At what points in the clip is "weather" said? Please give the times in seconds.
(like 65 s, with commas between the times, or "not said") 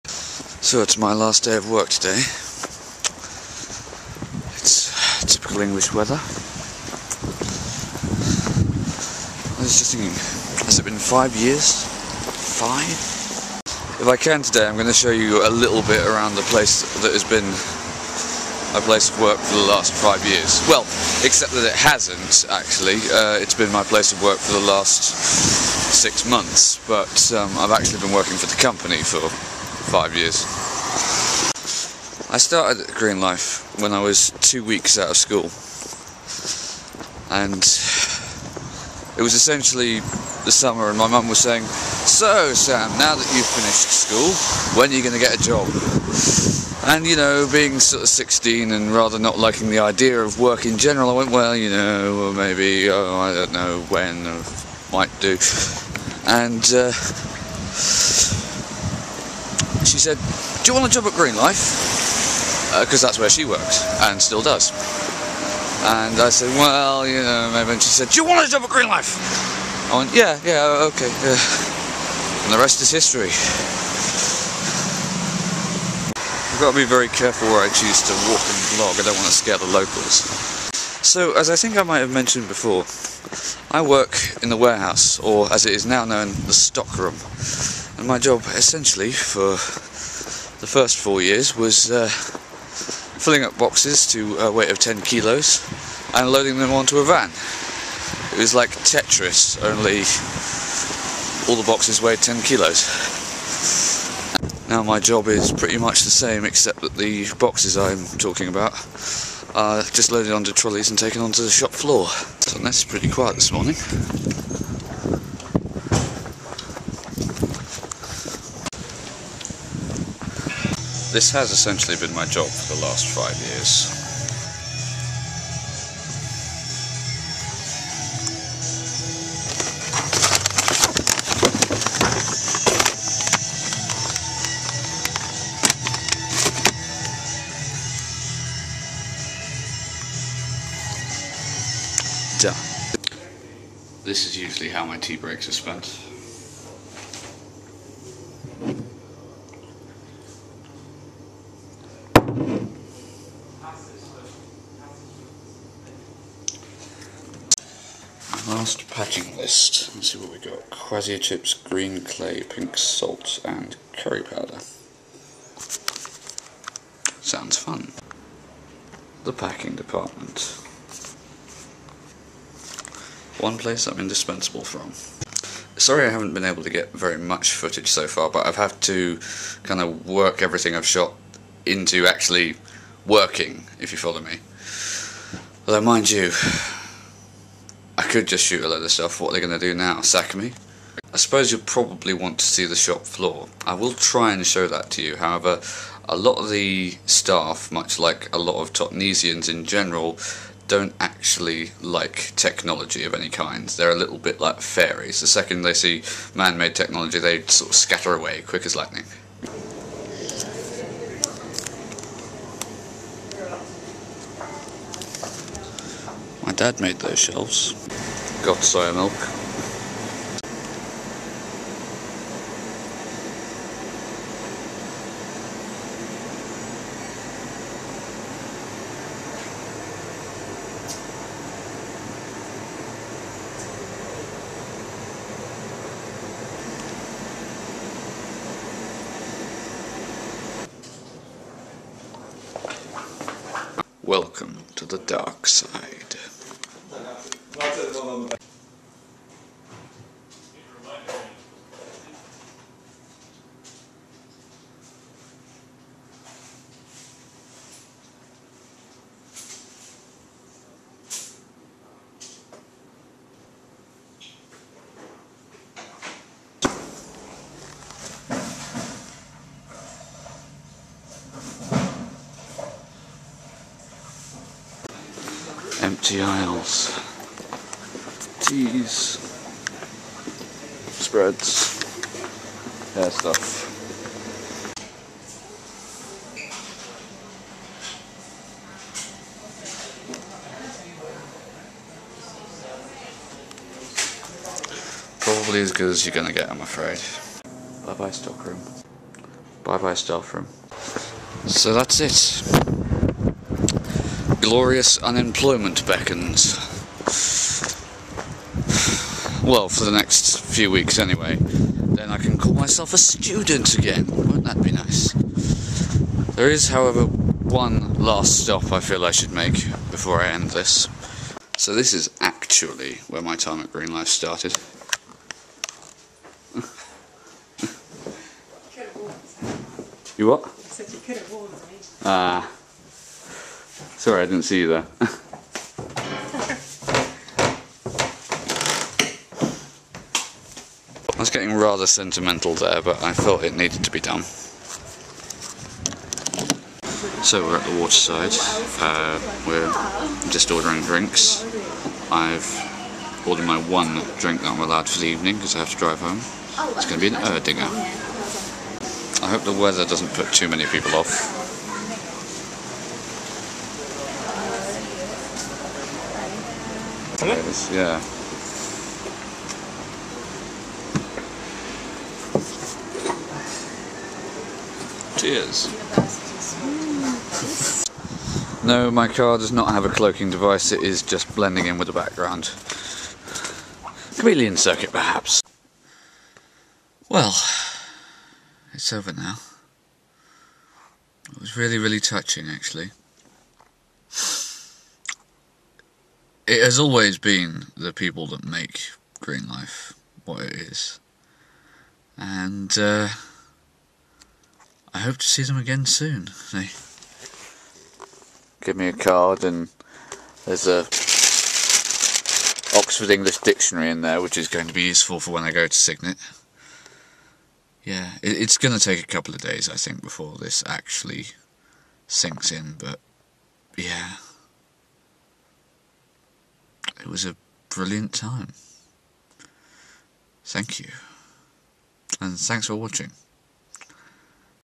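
5 s, 359 s.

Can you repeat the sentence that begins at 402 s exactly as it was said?
And, uh, I hope to see them again soon.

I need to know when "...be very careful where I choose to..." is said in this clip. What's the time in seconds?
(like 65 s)
76 s.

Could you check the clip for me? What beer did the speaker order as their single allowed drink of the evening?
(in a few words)
Erdinger.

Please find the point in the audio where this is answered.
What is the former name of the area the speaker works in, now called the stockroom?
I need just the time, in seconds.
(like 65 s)
84 s.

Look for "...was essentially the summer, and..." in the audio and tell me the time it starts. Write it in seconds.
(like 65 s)
39 s.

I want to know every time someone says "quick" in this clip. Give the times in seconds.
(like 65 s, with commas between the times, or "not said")
208 s.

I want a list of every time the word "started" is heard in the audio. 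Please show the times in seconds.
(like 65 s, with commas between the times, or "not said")
32 s, 324 s.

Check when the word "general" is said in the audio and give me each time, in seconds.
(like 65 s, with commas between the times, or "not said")
50 s, 199 s.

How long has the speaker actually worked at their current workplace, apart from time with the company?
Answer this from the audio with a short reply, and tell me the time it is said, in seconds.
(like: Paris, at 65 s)
six months, at 25 s.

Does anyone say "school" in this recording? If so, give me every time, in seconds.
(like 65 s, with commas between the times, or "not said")
35 s, 43 s.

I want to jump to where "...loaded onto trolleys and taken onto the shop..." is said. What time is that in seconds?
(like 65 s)
110 s.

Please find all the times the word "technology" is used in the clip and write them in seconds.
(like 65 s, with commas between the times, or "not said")
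202 s, 206 s.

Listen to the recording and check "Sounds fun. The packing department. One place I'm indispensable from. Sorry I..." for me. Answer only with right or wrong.
right.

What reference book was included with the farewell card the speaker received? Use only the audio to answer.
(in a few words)
Oxford English Dictionary.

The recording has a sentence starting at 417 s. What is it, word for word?
Yeah, it, it's going to take a couple of days, I think, before this actually sinks in, but yeah.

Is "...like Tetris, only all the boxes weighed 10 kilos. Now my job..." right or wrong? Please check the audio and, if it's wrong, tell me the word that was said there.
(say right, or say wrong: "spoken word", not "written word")
right.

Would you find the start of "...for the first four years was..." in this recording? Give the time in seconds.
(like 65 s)
89 s.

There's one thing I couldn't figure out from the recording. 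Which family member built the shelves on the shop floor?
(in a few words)
Dad.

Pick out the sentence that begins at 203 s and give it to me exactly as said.
They're a little bit like fairies.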